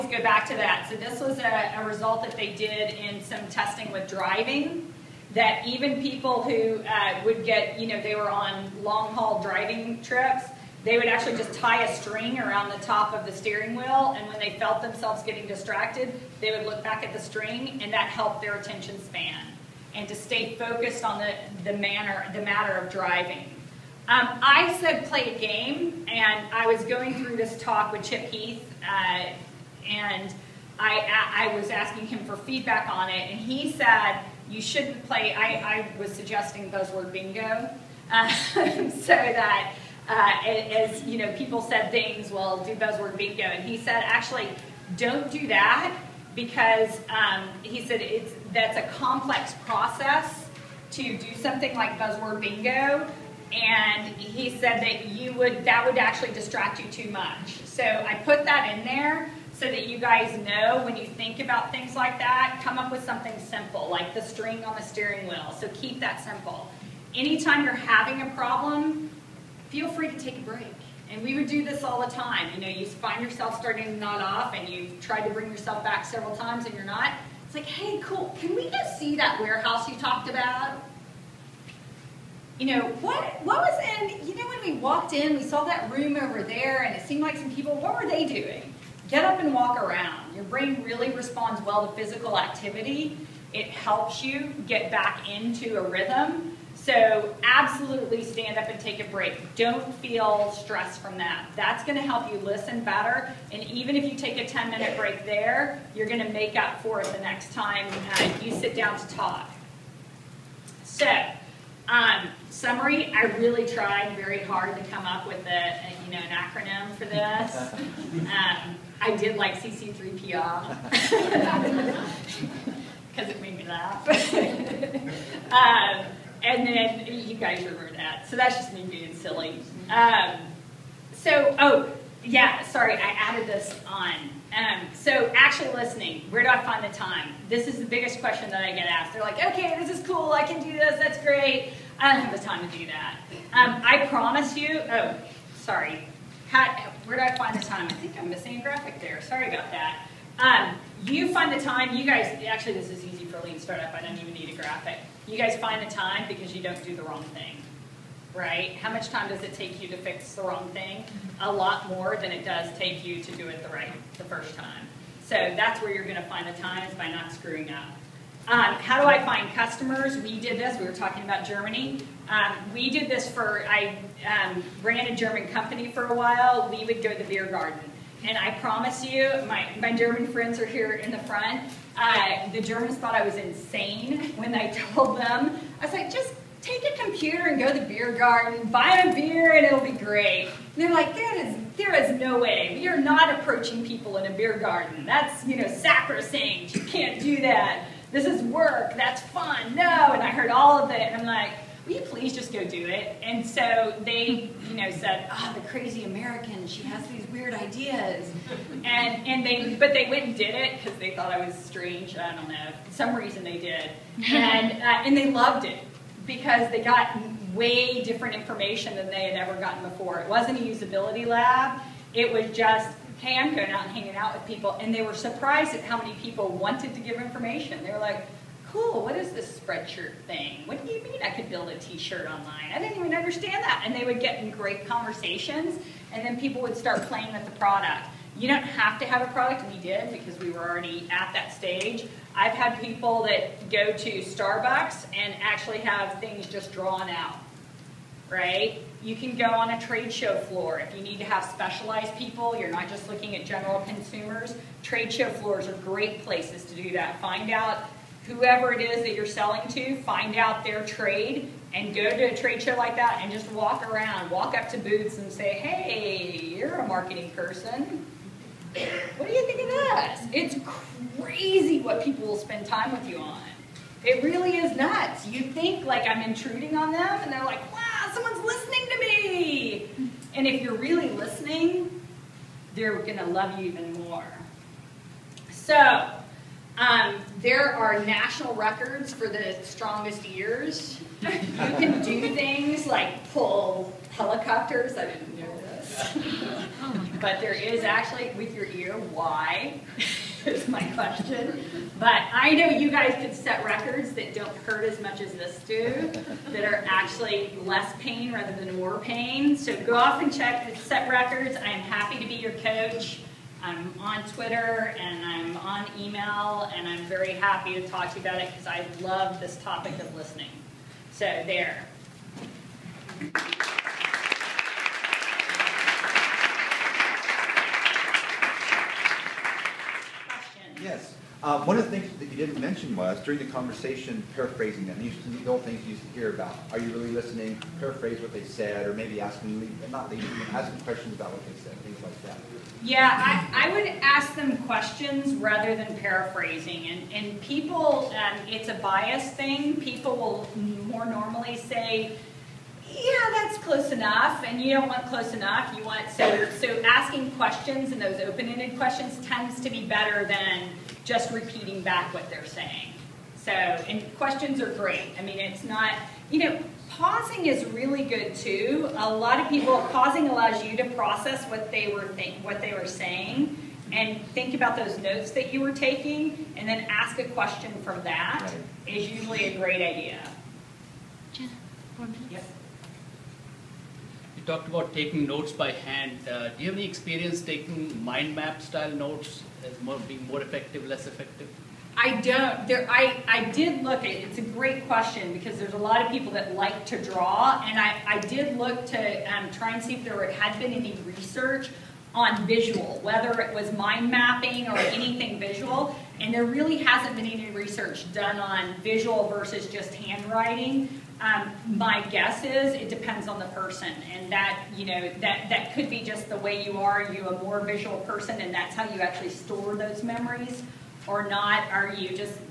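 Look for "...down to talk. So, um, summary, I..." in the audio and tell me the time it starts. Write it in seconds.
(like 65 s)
108 s.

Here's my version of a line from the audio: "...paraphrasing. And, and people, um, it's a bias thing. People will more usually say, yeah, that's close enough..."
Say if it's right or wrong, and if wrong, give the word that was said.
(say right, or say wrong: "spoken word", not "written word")
wrong: "normally", not "usually".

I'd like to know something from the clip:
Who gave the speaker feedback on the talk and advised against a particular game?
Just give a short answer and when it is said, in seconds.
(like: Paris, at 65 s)
Chip Heath, at 28 s.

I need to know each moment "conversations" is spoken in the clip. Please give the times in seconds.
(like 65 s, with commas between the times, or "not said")
234 s, 333 s.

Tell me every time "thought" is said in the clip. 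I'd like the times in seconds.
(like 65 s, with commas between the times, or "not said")
182 s, 211 s.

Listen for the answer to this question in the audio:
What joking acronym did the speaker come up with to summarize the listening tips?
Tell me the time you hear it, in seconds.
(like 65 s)
119 s.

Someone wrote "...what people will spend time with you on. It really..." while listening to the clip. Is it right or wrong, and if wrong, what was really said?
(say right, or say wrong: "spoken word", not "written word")
right.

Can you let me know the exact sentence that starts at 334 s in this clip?
These the old things you used to hear about.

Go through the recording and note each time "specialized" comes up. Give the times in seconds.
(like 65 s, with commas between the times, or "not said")
251 s.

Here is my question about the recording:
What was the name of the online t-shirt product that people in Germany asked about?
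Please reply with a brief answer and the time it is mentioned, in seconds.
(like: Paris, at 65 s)
Spreadshirt, at 229 s.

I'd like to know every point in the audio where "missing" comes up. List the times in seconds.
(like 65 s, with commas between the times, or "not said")
148 s.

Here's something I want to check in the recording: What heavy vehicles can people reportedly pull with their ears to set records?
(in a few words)
Helicopters.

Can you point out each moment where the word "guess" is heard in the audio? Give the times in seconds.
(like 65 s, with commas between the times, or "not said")
412 s.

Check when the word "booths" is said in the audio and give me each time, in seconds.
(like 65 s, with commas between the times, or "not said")
264 s.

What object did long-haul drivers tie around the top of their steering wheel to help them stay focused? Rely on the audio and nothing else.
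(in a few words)
A string.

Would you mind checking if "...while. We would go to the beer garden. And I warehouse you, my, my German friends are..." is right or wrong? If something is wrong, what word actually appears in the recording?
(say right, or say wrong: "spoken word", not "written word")
wrong: "promise", not "warehouse".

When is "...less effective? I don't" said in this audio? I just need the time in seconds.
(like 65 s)
390 s.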